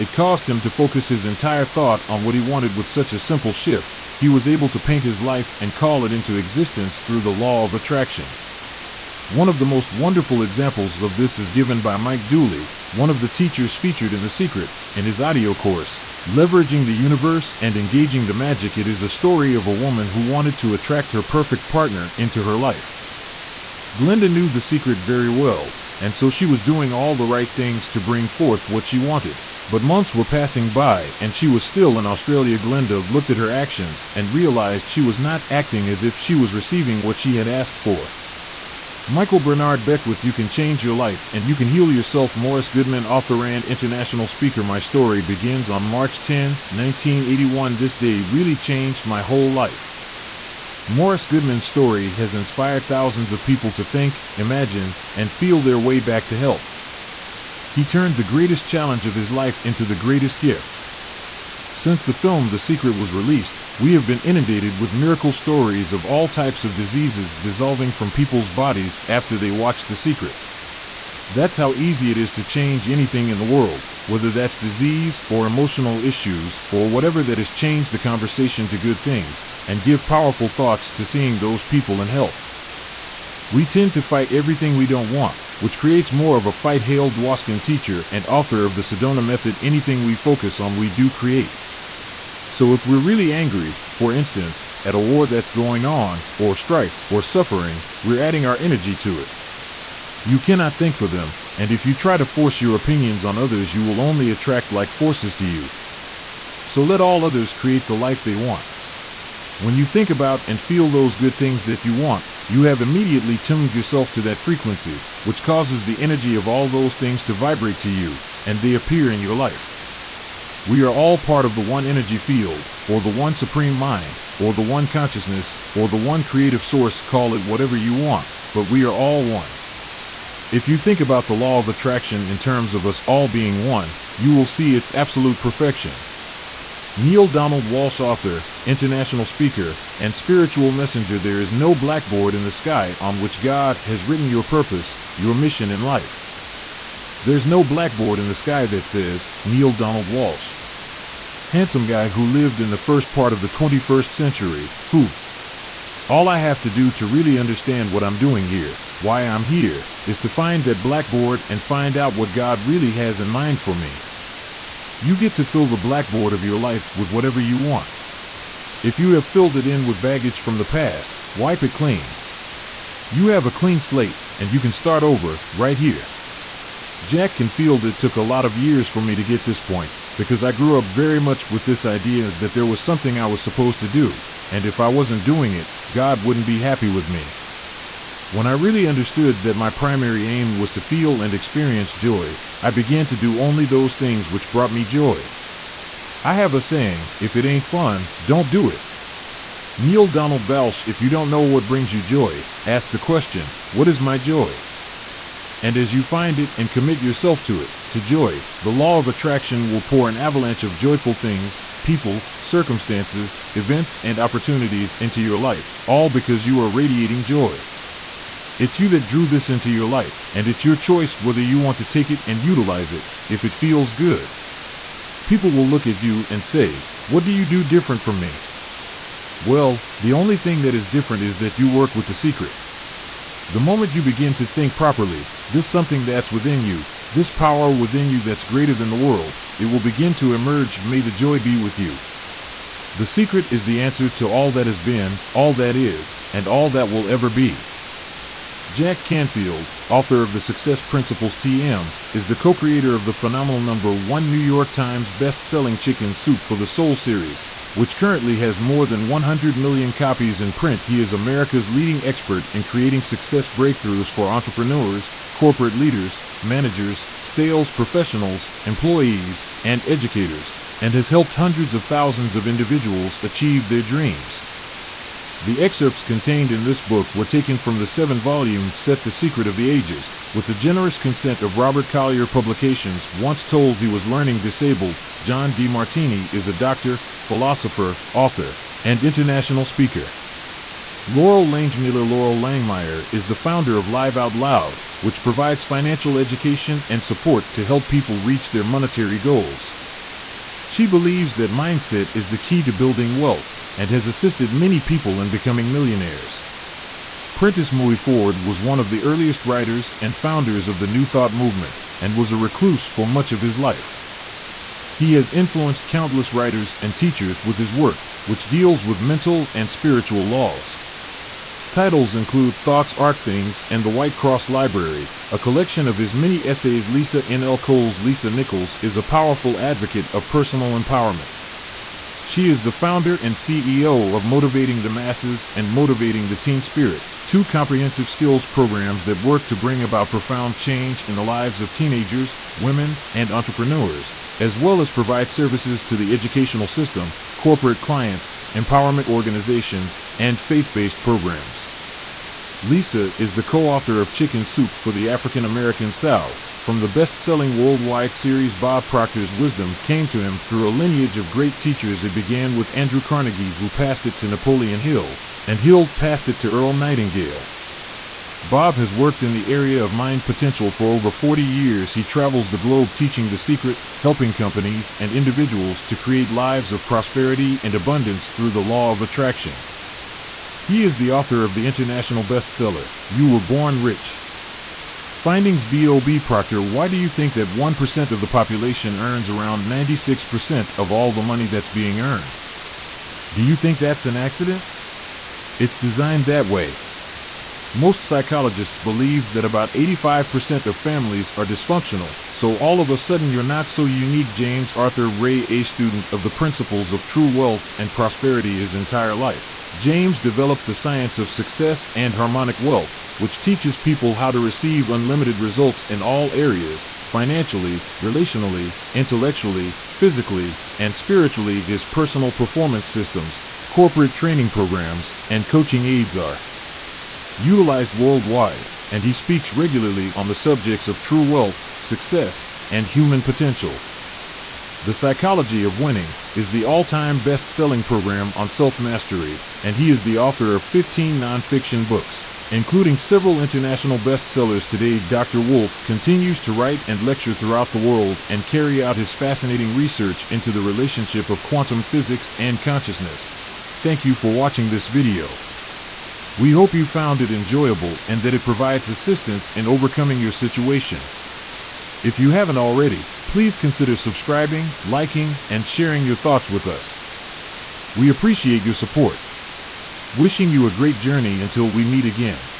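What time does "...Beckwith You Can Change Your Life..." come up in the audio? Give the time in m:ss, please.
0:39.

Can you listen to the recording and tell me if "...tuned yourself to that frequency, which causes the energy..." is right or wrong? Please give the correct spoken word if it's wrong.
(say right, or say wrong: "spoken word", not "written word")
right.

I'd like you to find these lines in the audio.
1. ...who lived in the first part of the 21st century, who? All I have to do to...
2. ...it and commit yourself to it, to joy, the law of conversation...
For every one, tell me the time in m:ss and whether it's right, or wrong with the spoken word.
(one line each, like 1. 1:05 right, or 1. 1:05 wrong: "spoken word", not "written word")
1. 2:32 right
2. 3:26 wrong: "attraction", not "conversation".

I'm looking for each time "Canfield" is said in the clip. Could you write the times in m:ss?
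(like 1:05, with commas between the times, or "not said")
2:57, 4:09.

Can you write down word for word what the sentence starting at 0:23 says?
Glenda knew the secret very well, and so she was doing all the right things to bring forth what she wanted.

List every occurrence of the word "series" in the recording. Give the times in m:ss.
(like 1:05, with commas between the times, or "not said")
4:16, 5:58.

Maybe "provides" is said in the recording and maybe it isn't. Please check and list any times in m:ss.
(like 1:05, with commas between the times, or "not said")
4:55, 5:44, 7:38.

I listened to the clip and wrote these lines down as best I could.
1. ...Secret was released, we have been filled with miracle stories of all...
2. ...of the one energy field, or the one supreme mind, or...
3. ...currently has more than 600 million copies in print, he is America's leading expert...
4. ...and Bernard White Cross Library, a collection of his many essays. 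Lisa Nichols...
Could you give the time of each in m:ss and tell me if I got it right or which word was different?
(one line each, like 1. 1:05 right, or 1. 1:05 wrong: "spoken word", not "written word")
1. 1:02 wrong: "inundated", not "filled"
2. 2:01 right
3. 4:17 wrong: "100", not "600"
4. 5:23 wrong: "The", not "Bernard".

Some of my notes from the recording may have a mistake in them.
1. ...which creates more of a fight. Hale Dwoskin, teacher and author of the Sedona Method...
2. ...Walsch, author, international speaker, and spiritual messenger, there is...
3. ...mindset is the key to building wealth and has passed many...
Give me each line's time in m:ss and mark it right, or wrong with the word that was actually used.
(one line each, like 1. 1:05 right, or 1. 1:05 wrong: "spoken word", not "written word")
1. 1:25 right
2. 2:17 right
3. 5:01 wrong: "assisted", not "passed".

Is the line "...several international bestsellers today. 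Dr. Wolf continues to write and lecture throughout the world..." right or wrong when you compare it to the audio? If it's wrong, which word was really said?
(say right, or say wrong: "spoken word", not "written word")
right.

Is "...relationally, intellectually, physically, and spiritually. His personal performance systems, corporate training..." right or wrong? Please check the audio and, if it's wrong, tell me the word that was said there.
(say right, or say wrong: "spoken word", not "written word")
right.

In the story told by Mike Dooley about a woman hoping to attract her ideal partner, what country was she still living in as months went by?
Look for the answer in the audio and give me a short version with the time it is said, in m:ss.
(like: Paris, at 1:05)
Australia, at 0:32.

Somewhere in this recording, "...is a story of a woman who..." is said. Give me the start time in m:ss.
0:18.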